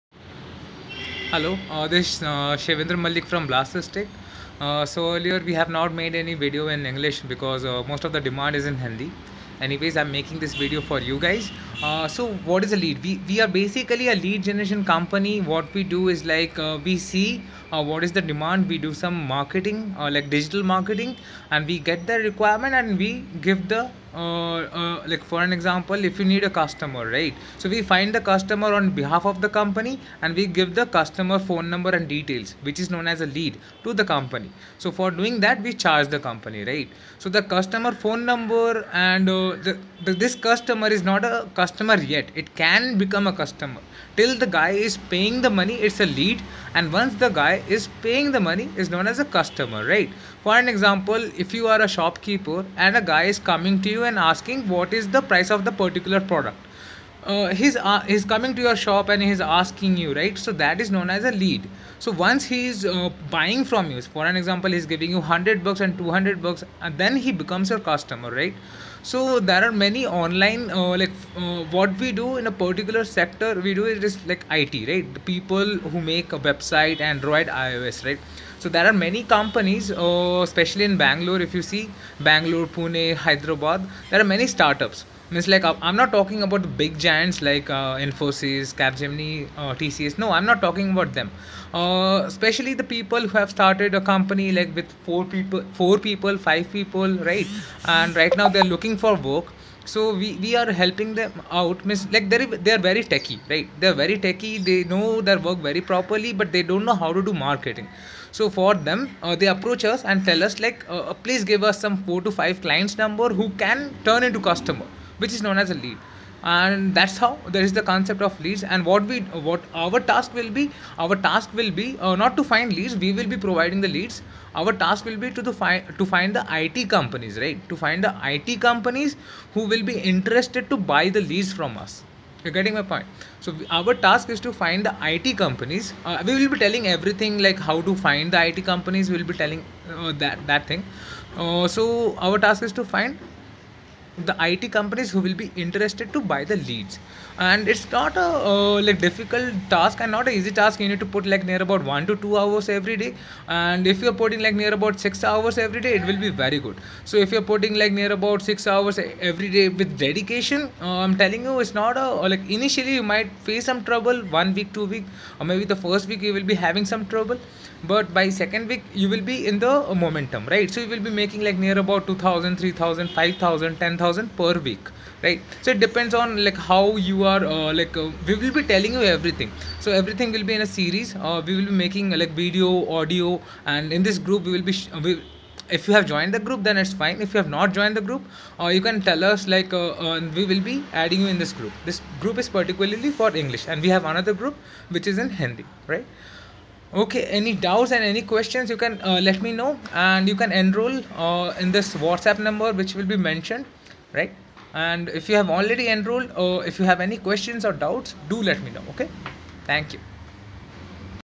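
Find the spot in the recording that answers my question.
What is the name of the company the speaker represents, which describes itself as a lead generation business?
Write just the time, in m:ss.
0:03.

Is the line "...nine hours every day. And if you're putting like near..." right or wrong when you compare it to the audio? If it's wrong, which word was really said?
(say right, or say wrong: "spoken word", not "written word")
wrong: "two", not "nine".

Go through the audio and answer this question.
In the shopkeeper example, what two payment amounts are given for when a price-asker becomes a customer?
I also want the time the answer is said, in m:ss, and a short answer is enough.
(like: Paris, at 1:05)
100 and 200, at 1:05.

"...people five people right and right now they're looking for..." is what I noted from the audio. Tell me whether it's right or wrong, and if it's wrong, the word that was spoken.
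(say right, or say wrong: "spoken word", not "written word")
right.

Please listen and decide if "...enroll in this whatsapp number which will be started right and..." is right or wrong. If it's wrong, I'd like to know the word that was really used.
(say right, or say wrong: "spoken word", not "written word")
wrong: "mentioned", not "started".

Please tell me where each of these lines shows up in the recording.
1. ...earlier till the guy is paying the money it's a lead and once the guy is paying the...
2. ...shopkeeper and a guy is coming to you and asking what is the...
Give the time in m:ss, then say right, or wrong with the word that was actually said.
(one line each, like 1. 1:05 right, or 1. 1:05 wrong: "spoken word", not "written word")
1. 0:43 wrong: "customer", not "earlier"
2. 0:51 right.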